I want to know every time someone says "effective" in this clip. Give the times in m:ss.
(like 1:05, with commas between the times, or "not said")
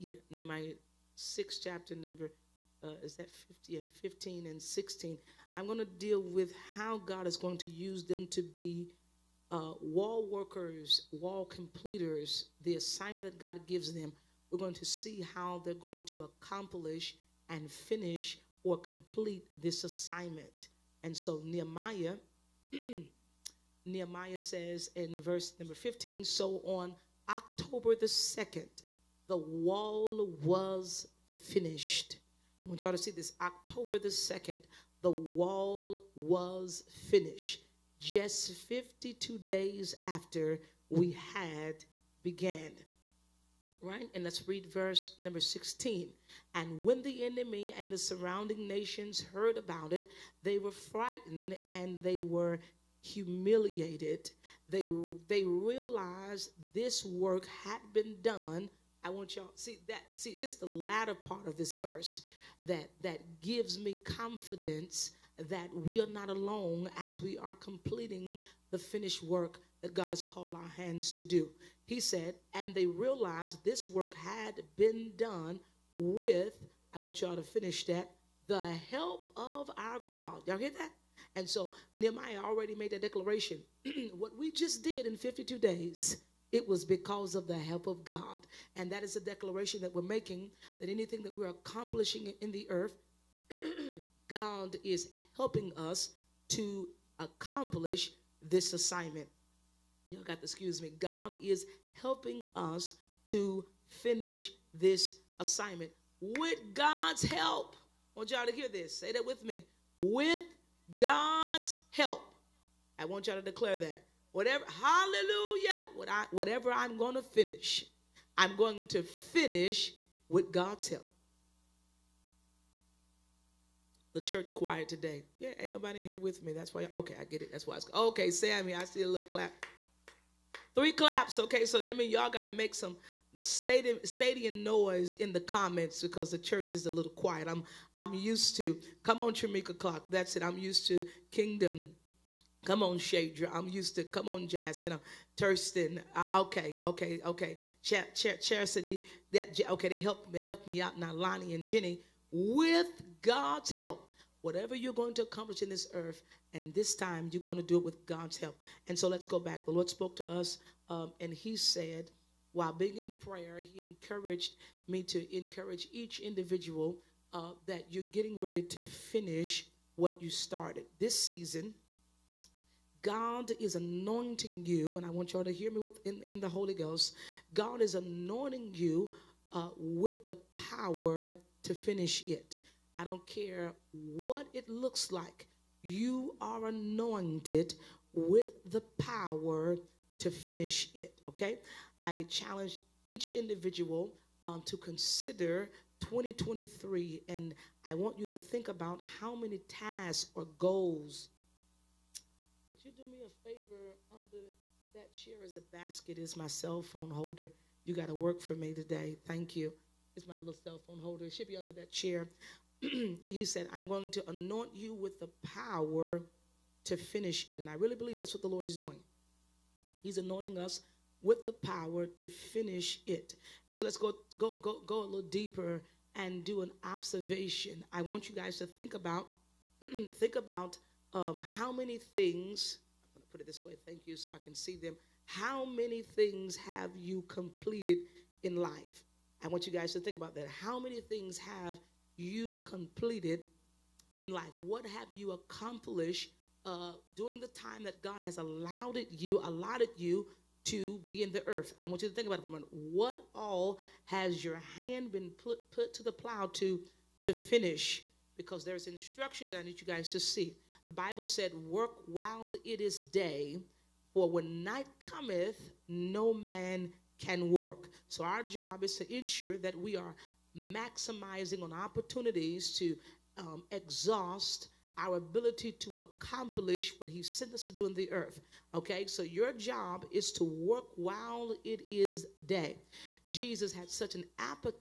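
not said.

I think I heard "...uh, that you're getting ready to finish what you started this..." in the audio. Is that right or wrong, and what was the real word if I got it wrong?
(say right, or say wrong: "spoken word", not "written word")
right.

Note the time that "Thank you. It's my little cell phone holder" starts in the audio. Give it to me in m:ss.
3:29.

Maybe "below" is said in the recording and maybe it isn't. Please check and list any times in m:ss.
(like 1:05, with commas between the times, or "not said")
not said.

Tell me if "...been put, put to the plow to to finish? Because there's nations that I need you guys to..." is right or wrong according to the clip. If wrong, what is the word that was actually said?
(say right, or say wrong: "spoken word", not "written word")
wrong: "instructions", not "nations".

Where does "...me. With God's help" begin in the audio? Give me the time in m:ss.
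1:49.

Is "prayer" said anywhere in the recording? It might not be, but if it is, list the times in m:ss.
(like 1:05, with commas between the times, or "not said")
2:43.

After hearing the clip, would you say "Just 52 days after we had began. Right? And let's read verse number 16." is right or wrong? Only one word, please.
right.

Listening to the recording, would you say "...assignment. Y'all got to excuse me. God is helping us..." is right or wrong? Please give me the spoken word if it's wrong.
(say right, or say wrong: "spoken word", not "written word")
right.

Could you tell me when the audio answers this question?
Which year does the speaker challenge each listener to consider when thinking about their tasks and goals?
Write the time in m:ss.
3:15.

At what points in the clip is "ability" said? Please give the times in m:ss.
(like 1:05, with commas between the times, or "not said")
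4:35.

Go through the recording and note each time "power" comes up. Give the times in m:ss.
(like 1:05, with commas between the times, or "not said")
3:00, 3:08, 3:35, 3:41.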